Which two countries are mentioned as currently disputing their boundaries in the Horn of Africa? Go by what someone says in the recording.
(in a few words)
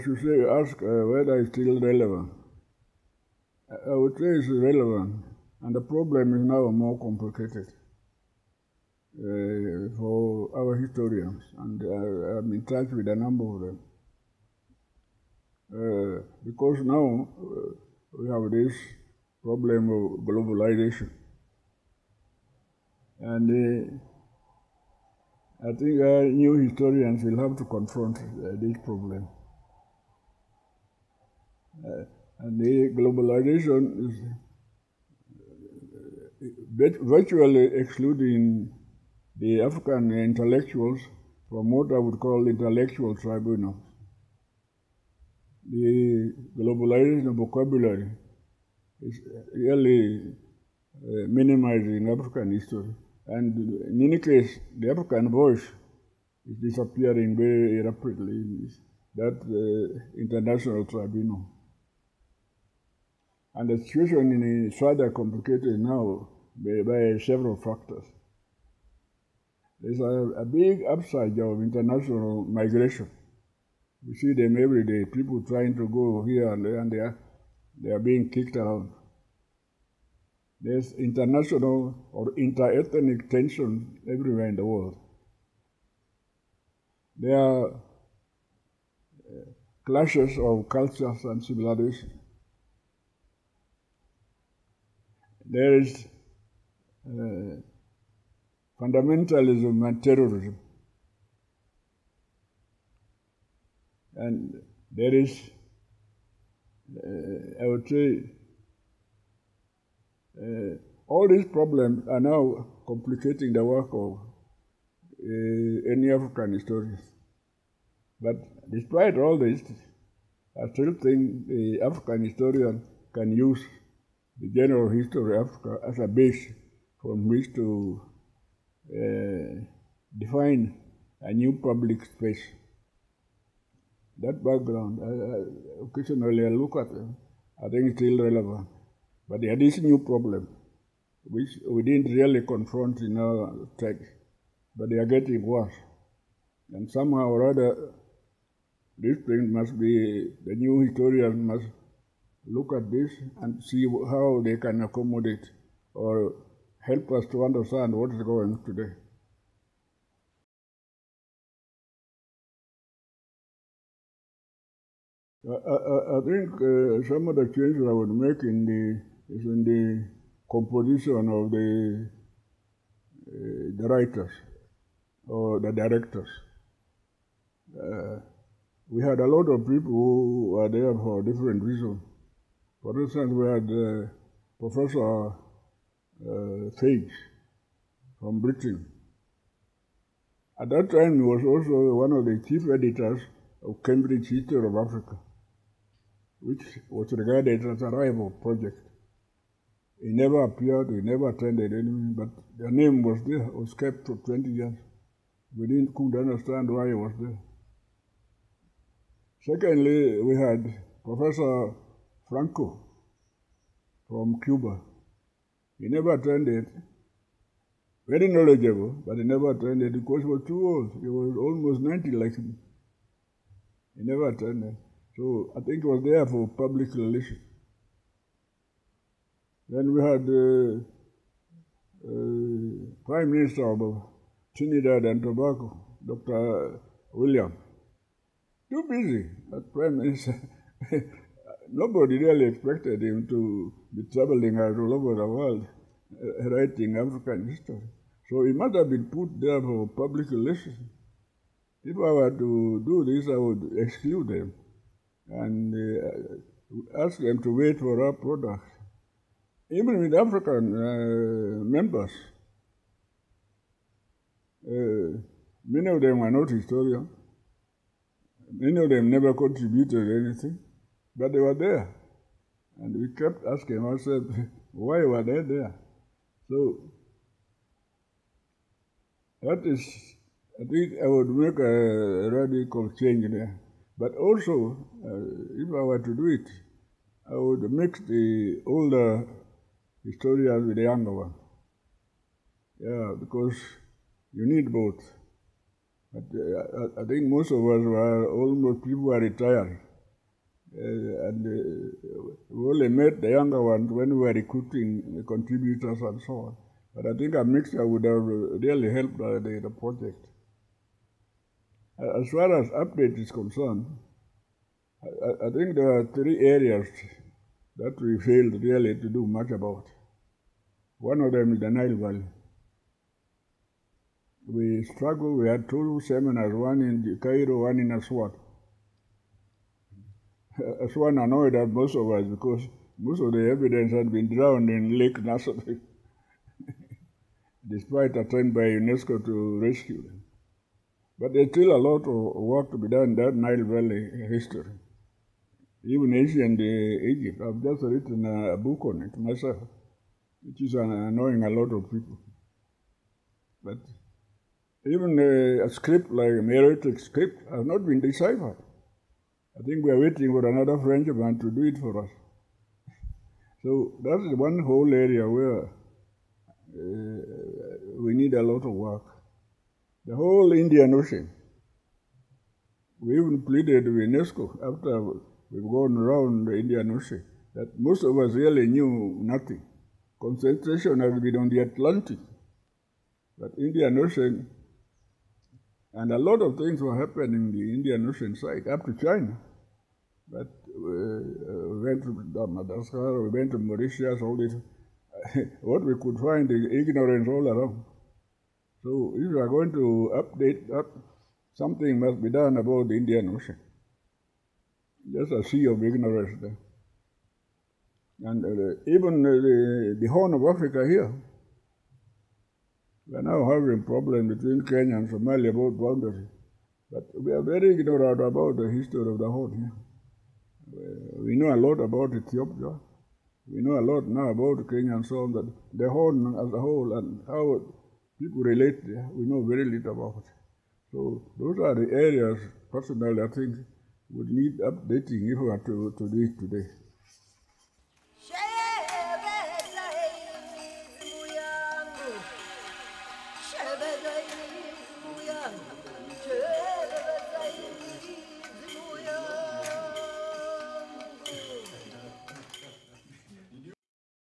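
Kenya and Somalia.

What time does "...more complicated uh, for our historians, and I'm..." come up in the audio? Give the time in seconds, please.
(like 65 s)
6 s.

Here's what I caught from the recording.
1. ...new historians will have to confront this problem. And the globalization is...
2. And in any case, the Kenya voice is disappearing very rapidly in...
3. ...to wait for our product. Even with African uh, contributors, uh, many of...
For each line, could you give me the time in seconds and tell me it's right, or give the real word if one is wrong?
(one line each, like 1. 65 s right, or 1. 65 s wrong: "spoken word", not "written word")
1. 26 s right
2. 53 s wrong: "African", not "Kenya"
3. 257 s wrong: "members", not "contributors".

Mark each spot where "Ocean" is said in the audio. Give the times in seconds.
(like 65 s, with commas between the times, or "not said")
370 s, 376 s, 383 s, 388 s, 403 s.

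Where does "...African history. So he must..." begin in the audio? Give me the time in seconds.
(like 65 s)
246 s.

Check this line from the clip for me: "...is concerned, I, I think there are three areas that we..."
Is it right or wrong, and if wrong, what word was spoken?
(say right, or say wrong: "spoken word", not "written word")
right.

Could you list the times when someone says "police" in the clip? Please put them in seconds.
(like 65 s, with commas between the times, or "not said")
not said.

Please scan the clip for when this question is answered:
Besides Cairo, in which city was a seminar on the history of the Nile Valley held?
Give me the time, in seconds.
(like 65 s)
327 s.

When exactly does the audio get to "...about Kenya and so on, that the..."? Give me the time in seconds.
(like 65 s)
424 s.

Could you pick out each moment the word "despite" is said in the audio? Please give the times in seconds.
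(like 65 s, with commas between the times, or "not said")
118 s, 337 s.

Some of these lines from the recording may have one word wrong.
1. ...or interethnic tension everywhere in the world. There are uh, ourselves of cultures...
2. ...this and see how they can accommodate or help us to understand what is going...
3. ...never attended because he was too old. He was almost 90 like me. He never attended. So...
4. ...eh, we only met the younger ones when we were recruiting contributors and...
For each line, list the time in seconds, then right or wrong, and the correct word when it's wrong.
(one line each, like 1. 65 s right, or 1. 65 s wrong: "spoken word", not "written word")
1. 82 s wrong: "clashes", not "ourselves"
2. 152 s right
3. 219 s right
4. 301 s right.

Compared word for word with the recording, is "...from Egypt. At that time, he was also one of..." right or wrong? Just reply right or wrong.
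wrong.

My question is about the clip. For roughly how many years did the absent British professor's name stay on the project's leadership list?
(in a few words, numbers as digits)
20.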